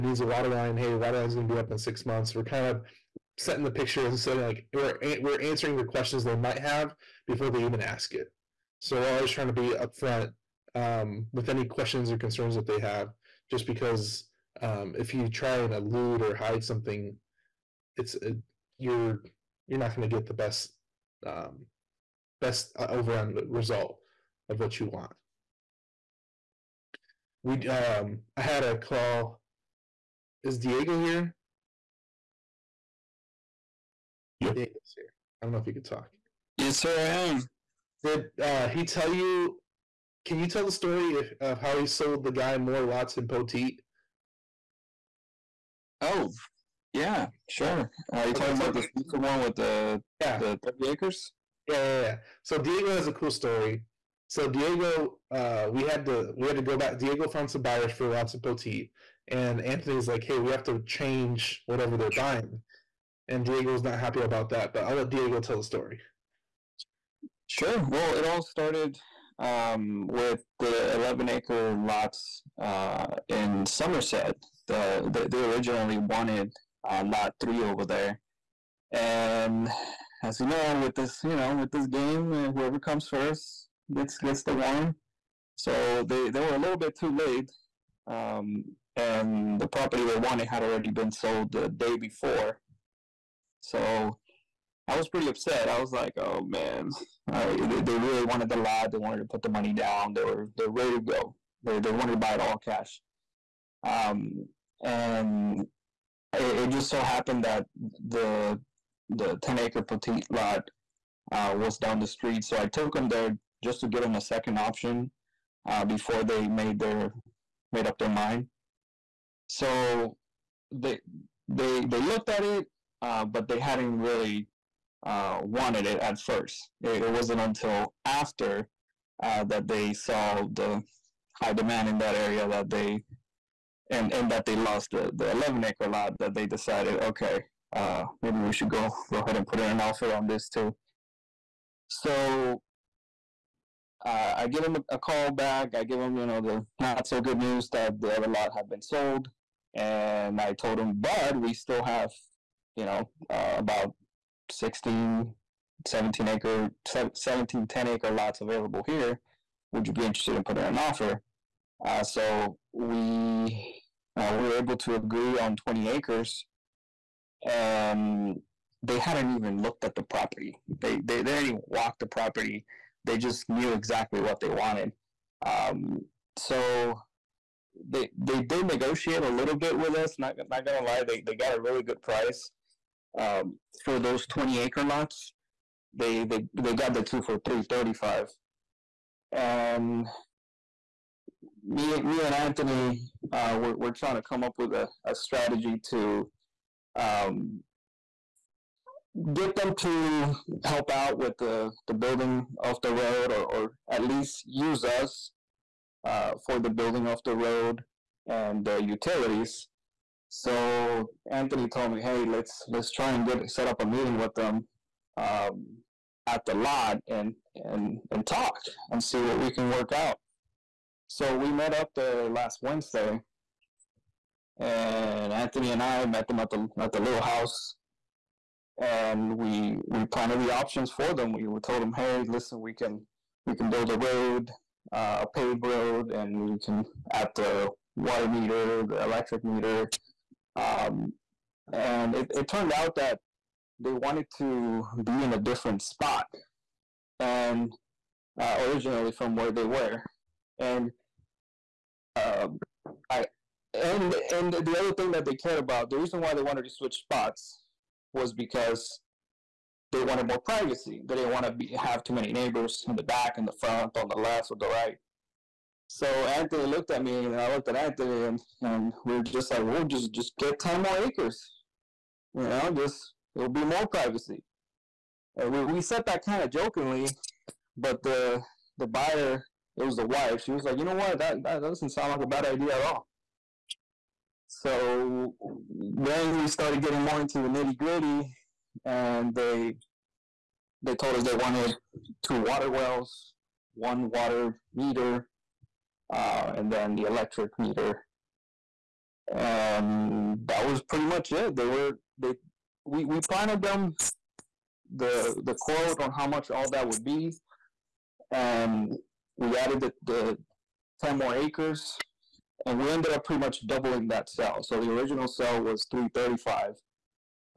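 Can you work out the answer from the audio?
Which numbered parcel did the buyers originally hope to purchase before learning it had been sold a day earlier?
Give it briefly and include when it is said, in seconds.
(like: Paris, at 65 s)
Lot 3, at 77 s.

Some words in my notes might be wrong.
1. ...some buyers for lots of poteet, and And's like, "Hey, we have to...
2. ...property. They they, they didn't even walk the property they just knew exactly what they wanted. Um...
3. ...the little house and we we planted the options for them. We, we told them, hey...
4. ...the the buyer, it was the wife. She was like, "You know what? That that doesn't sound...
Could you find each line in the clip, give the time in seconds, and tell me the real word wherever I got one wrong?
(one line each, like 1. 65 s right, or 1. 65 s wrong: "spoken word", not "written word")
1. 57 s wrong: "Anthony", not "And"
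2. 170 s right
3. 226 s right
4. 278 s right.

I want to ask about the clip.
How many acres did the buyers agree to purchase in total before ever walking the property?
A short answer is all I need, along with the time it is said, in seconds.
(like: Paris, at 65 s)
20 acres, at 165 s.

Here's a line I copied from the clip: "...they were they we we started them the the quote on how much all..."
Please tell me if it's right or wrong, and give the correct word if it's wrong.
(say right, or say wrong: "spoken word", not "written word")
wrong: "planted", not "started".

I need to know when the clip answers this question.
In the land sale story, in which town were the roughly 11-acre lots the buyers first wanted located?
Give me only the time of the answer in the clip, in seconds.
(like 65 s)
73 s.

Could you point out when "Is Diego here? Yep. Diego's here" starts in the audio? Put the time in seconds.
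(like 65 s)
30 s.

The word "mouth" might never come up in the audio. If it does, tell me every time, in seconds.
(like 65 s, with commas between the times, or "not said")
not said.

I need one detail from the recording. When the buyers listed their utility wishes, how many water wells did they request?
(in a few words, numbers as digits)
2.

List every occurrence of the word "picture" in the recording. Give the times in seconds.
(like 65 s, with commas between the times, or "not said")
3 s.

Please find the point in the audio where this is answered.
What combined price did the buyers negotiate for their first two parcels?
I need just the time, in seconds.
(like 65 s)
187 s.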